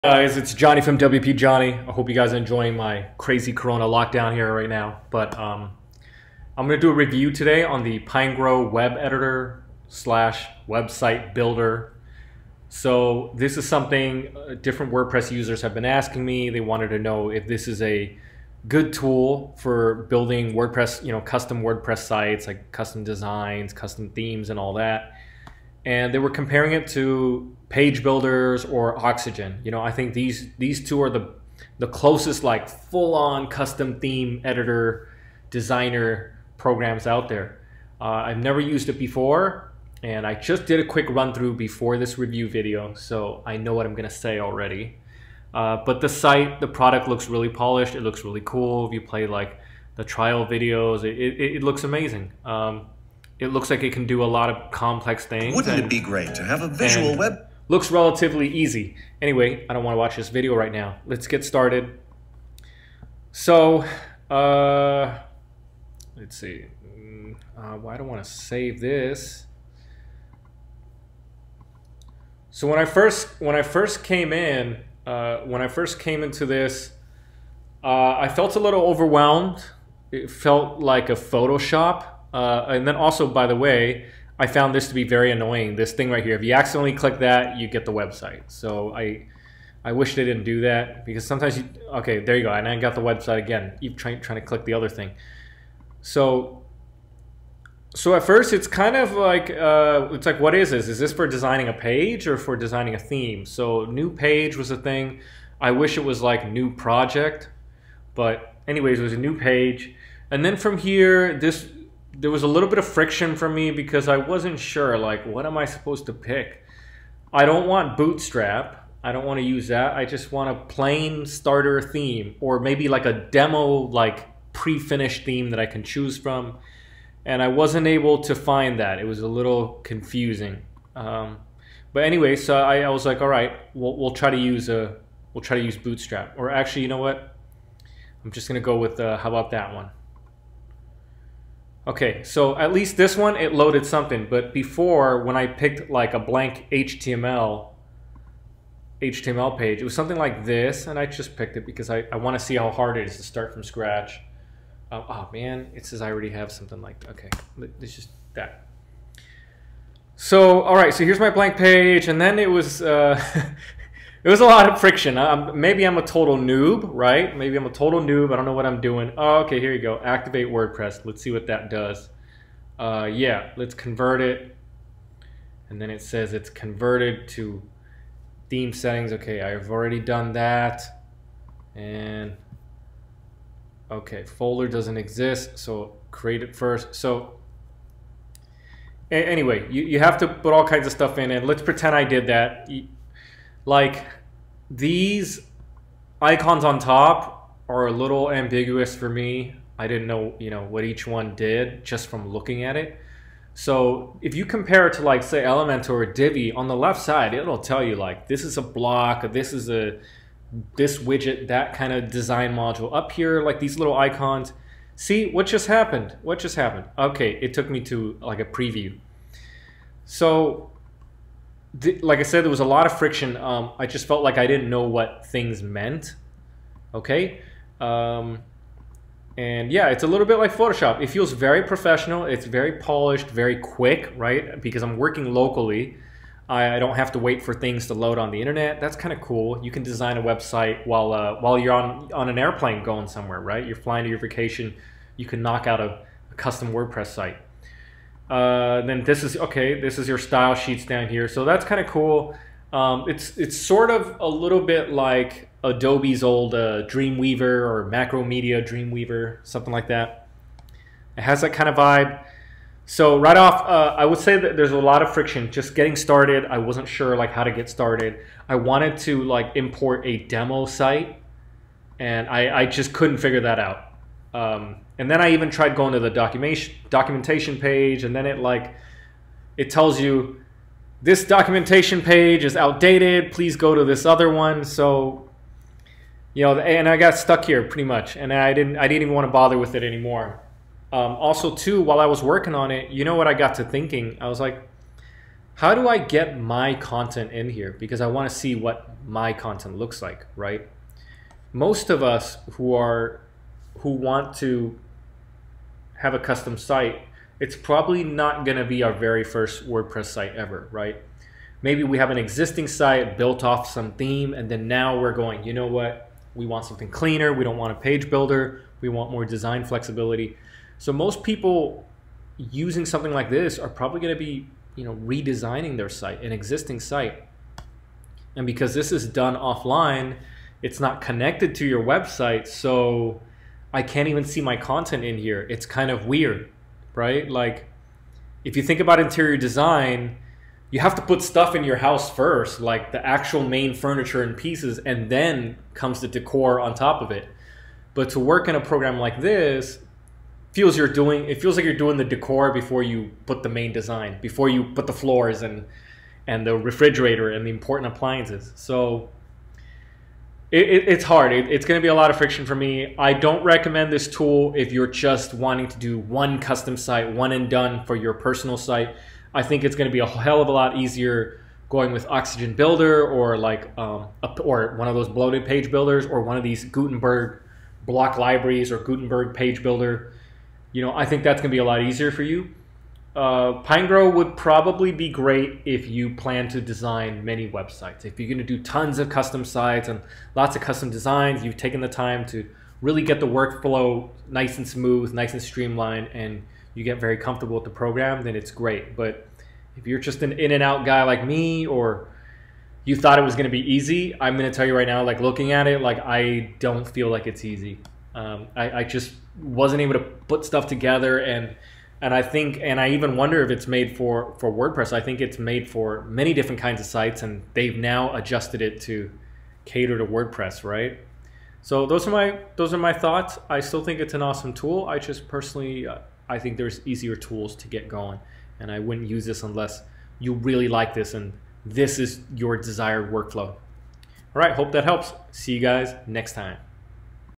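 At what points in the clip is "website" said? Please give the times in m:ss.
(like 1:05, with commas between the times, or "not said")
0:10, 1:27, 1:33, 4:00, 5:31, 6:27.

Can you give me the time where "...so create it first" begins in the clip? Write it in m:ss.
3:05.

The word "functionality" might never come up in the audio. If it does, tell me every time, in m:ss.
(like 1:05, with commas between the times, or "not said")
not said.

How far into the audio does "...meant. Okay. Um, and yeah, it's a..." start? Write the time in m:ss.
3:45.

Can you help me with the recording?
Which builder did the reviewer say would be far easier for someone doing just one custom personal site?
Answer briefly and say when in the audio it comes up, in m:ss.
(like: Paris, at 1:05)
Oxygen Builder, at 6:12.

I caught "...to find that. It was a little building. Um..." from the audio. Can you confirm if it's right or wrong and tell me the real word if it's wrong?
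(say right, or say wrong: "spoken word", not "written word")
wrong: "confusing", not "building".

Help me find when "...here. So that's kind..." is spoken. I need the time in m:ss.
4:11.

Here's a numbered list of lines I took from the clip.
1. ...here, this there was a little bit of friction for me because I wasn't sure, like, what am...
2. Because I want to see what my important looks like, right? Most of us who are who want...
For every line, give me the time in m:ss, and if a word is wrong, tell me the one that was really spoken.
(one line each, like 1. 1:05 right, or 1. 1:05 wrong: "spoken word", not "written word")
1. 1:50 right
2. 4:57 wrong: "content", not "important".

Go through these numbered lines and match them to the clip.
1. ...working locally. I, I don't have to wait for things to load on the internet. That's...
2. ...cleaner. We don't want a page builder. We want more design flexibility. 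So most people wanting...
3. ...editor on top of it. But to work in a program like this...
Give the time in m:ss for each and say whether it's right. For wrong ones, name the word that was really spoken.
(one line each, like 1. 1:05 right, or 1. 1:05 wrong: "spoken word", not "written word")
1. 3:54 right
2. 5:16 wrong: "using", not "wanting"
3. 5:46 wrong: "decor", not "editor".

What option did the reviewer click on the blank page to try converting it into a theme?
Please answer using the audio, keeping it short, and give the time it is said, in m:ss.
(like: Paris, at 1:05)
Activate WordPress, at 2:50.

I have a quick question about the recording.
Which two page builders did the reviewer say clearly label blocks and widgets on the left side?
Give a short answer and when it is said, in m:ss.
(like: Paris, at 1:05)
Elementor or Divi, at 3:25.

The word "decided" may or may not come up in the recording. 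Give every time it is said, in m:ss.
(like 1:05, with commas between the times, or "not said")
not said.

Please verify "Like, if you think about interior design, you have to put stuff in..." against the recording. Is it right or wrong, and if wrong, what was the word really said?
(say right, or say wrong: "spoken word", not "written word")
right.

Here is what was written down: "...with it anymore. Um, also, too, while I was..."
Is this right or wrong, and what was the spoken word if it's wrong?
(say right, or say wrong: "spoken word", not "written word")
right.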